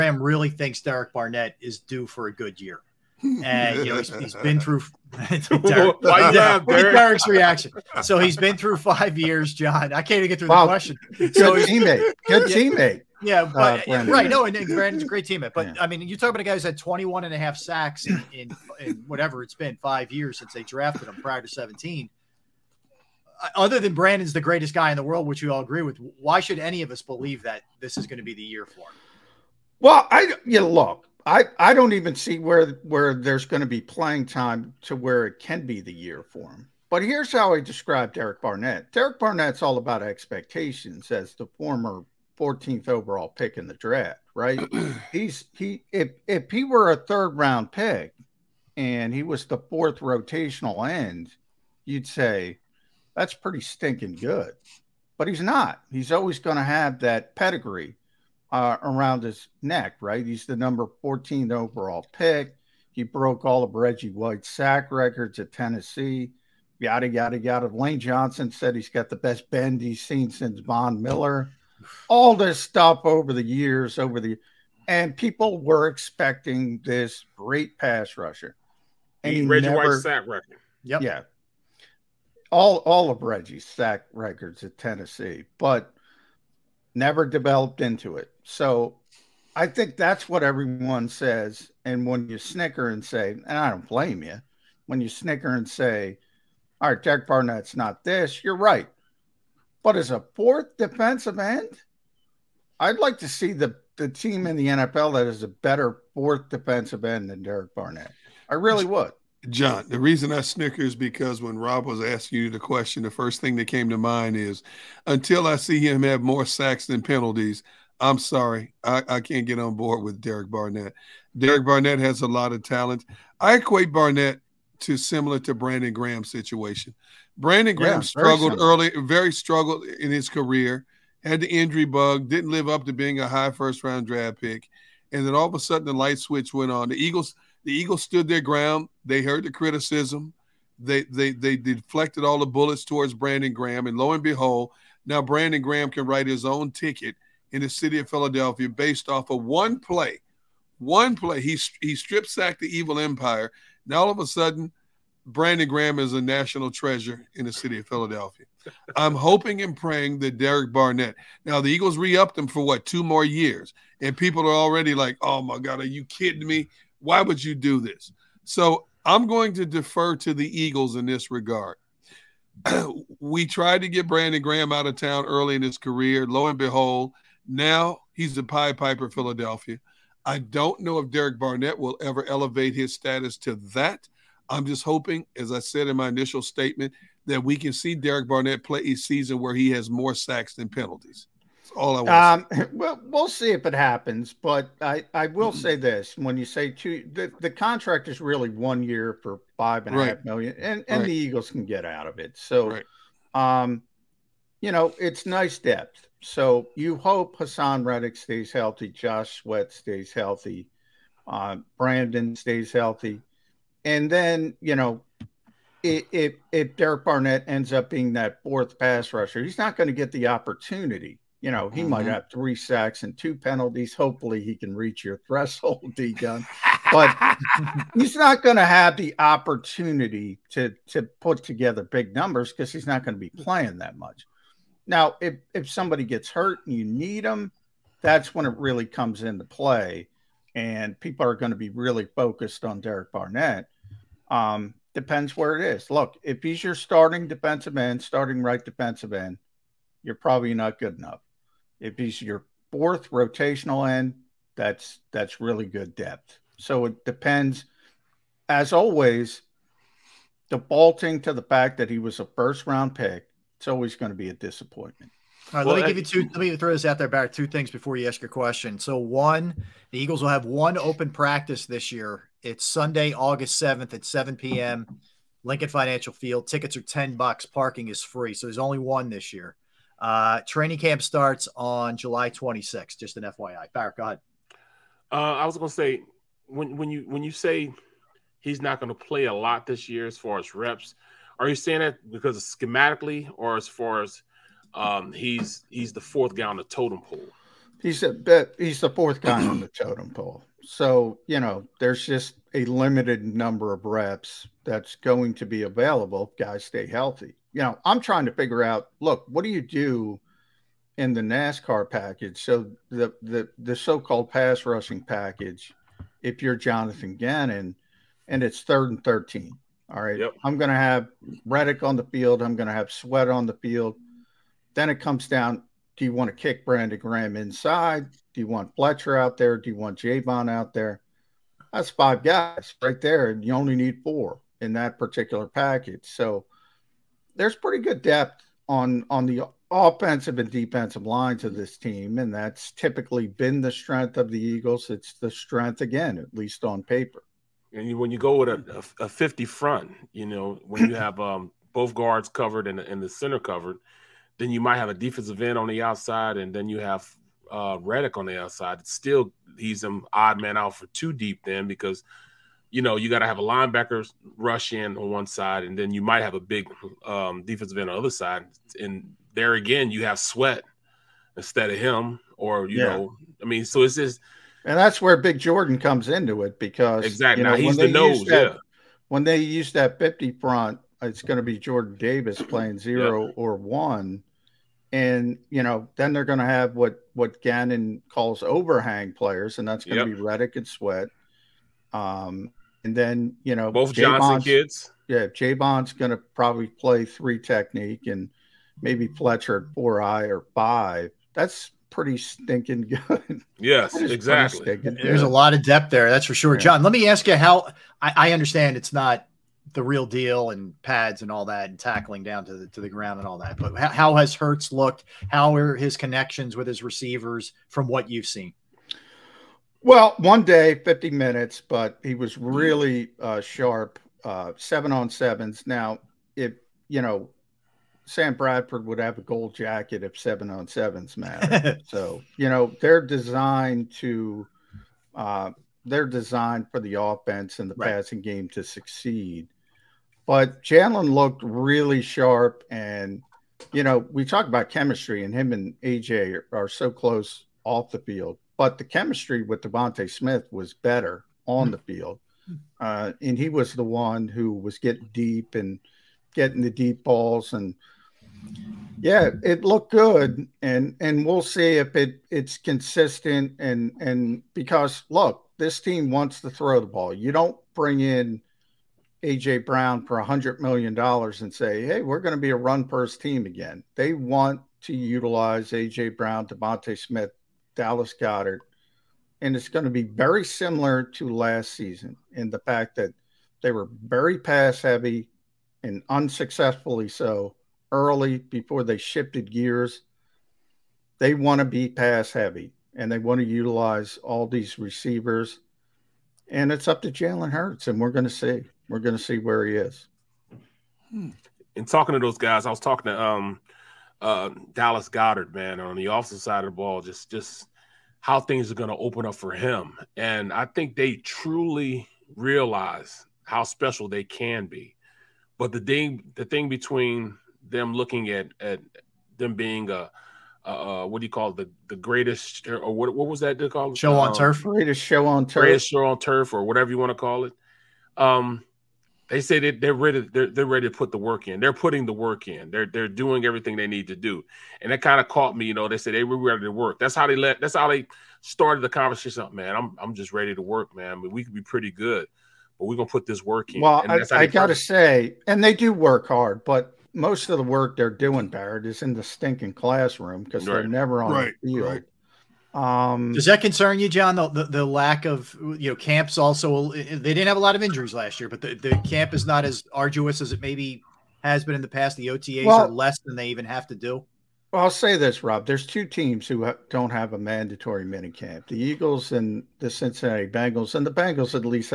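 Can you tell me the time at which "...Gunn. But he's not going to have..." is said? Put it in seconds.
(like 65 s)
226 s.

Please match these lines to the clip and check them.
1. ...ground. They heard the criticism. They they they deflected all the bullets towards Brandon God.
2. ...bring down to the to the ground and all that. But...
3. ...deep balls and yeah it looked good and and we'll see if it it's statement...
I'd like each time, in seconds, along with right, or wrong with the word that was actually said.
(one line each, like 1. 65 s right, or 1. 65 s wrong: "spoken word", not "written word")
1. 138 s wrong: "Graham", not "God"
2. 411 s wrong: "tackling", not "bring"
3. 456 s wrong: "consistent", not "statement".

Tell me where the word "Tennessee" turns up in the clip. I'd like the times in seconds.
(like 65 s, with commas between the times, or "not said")
65 s, 84 s.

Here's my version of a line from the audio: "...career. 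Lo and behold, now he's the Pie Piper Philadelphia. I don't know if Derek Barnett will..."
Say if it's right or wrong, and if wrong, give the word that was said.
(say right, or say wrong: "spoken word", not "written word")
right.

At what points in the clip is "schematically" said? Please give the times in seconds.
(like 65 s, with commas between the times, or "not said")
292 s.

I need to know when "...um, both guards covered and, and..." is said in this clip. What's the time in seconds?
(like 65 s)
351 s.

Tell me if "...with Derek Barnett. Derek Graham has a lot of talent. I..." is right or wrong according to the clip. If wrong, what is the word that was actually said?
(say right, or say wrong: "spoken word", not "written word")
wrong: "Barnett", not "Graham".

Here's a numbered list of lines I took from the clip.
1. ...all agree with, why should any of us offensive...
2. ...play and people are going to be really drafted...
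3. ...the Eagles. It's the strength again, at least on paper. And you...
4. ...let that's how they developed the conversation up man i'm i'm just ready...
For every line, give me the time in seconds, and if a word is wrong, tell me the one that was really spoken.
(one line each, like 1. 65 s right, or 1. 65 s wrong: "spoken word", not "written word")
1. 25 s wrong: "believe", not "offensive"
2. 239 s wrong: "focused", not "drafted"
3. 344 s right
4. 537 s wrong: "started", not "developed".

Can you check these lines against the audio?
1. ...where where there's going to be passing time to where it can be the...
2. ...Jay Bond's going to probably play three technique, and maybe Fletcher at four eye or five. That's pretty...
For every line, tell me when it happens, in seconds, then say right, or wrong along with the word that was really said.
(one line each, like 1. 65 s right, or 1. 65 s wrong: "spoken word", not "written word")
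1. 32 s wrong: "playing", not "passing"
2. 395 s right.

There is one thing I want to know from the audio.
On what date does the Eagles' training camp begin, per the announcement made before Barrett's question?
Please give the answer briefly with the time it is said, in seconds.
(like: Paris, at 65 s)
July 26, at 281 s.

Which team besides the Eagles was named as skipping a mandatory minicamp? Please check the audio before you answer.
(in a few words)
Cincinnati Bengals.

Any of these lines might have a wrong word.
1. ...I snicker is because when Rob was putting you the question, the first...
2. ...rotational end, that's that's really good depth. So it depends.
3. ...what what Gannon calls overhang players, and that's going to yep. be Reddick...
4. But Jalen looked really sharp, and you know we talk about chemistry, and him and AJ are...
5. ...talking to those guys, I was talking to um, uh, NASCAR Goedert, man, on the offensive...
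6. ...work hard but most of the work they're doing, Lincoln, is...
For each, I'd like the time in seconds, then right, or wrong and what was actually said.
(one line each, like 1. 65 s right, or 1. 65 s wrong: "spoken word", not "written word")
1. 110 s wrong: "asking", not "putting"
2. 253 s right
3. 386 s right
4. 440 s right
5. 501 s wrong: "Dallas", not "NASCAR"
6. 545 s wrong: "Barrett", not "Lincoln".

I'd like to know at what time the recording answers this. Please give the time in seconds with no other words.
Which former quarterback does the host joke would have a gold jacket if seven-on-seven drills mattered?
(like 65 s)
428 s.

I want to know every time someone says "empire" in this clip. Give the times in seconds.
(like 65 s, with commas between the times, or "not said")
152 s.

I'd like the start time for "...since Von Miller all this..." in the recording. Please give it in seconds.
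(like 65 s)
70 s.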